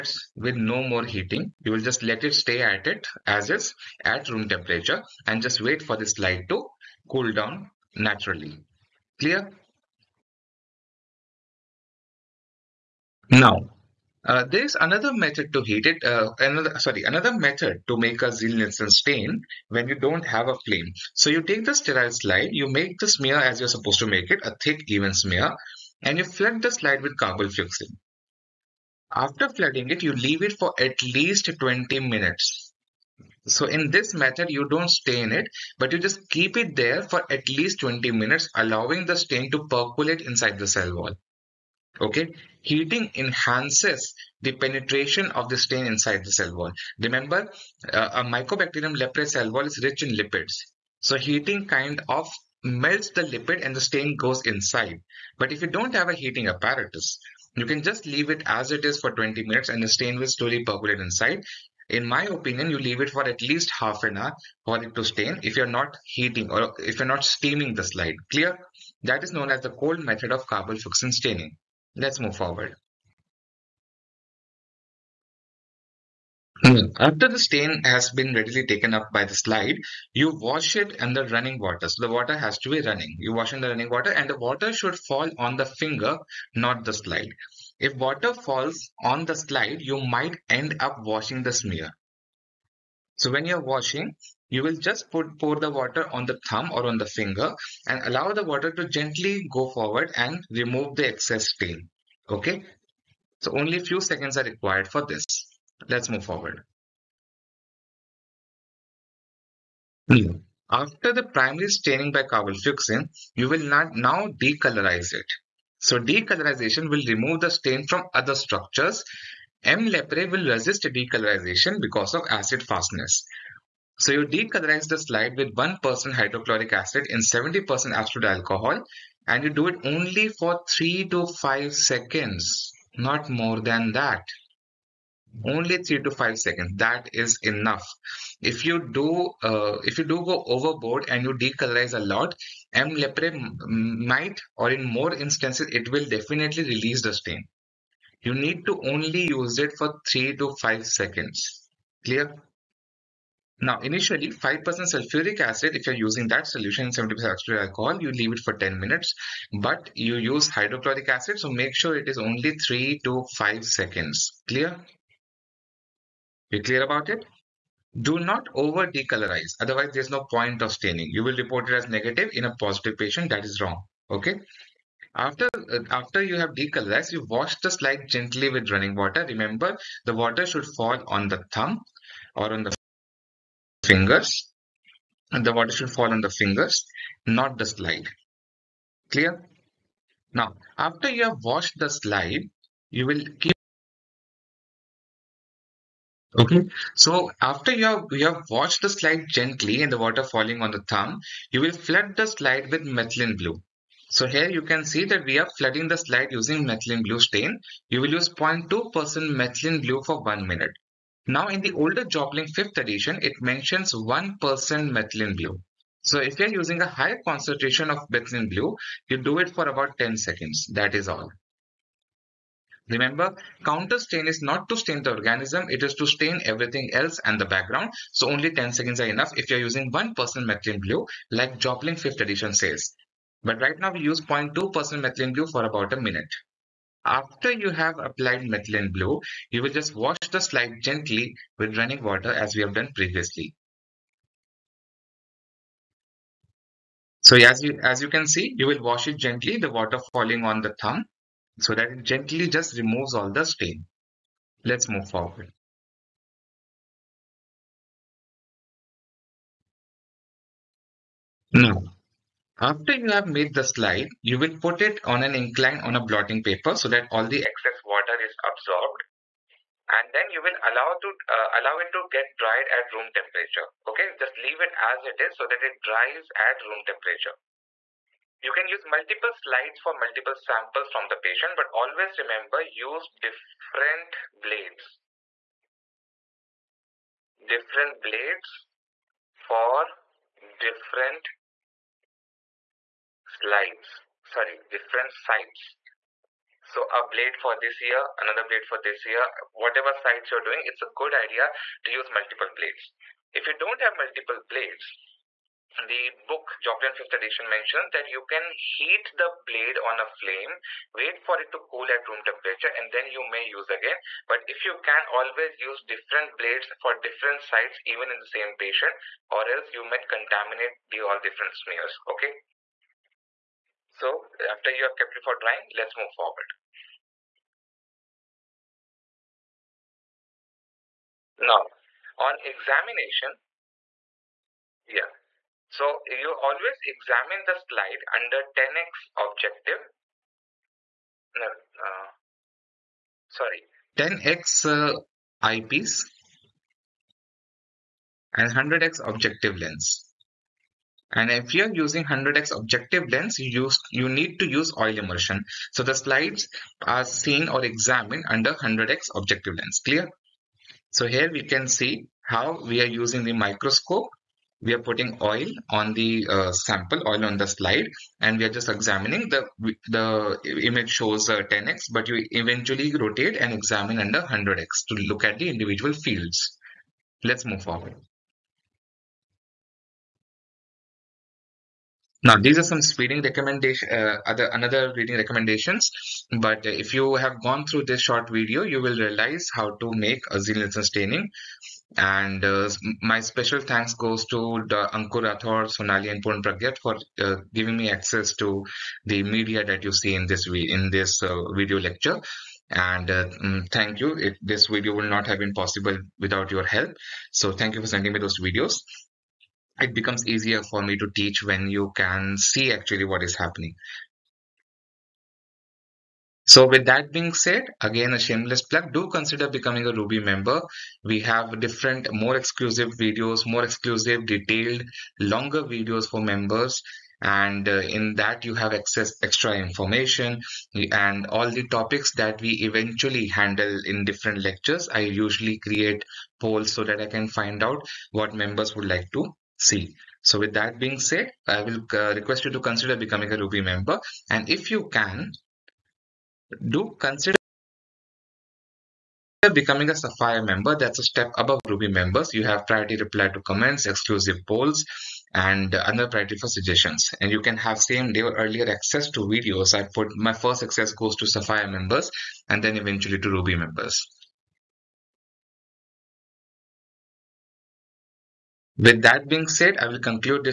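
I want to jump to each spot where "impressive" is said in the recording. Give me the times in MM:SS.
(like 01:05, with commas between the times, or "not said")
not said.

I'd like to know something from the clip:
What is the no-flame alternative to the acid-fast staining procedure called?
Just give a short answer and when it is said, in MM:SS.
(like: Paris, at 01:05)
cold method, at 01:09.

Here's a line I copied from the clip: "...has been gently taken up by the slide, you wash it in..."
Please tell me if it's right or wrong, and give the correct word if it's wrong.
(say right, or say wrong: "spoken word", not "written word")
wrong: "readily", not "gently".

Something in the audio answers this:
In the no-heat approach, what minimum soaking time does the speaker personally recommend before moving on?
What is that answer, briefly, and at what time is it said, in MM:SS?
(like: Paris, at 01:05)
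half an hour, at 01:03.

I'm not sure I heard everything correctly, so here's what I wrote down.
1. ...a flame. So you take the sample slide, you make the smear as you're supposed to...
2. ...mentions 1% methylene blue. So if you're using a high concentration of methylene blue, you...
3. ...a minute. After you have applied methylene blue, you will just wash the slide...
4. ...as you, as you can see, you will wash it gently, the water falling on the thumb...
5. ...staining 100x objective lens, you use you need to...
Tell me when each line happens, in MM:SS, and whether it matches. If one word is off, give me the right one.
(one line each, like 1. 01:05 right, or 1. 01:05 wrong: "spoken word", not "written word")
1. 00:20 wrong: "sterile", not "sample"
2. 03:33 right
3. 03:55 right
4. 04:07 right
5. 05:51 wrong: "using", not "staining".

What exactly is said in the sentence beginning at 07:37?
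And you can have same day or earlier access to videos.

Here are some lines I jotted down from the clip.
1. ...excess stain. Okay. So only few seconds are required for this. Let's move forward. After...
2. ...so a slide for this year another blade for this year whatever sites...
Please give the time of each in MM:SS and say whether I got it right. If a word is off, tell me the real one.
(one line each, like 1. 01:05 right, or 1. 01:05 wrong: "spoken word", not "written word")
1. 01:41 right
2. 04:56 wrong: "blade", not "slide".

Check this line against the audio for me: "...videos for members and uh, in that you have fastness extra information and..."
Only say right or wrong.
wrong.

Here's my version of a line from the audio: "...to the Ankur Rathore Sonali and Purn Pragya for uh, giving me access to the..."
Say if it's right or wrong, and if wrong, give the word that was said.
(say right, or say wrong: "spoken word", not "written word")
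right.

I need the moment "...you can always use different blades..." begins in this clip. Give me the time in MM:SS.
05:14.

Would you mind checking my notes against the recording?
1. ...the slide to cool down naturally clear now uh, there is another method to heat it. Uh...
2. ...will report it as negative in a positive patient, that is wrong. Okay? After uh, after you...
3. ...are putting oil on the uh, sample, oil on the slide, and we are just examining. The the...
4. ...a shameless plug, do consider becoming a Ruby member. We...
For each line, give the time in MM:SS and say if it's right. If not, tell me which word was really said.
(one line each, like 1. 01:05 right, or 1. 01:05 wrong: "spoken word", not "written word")
1. 00:05 right
2. 02:51 right
3. 06:04 right
4. 06:58 right.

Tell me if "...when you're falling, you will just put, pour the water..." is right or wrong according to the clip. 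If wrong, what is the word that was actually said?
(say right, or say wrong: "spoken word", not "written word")
wrong: "washing", not "falling".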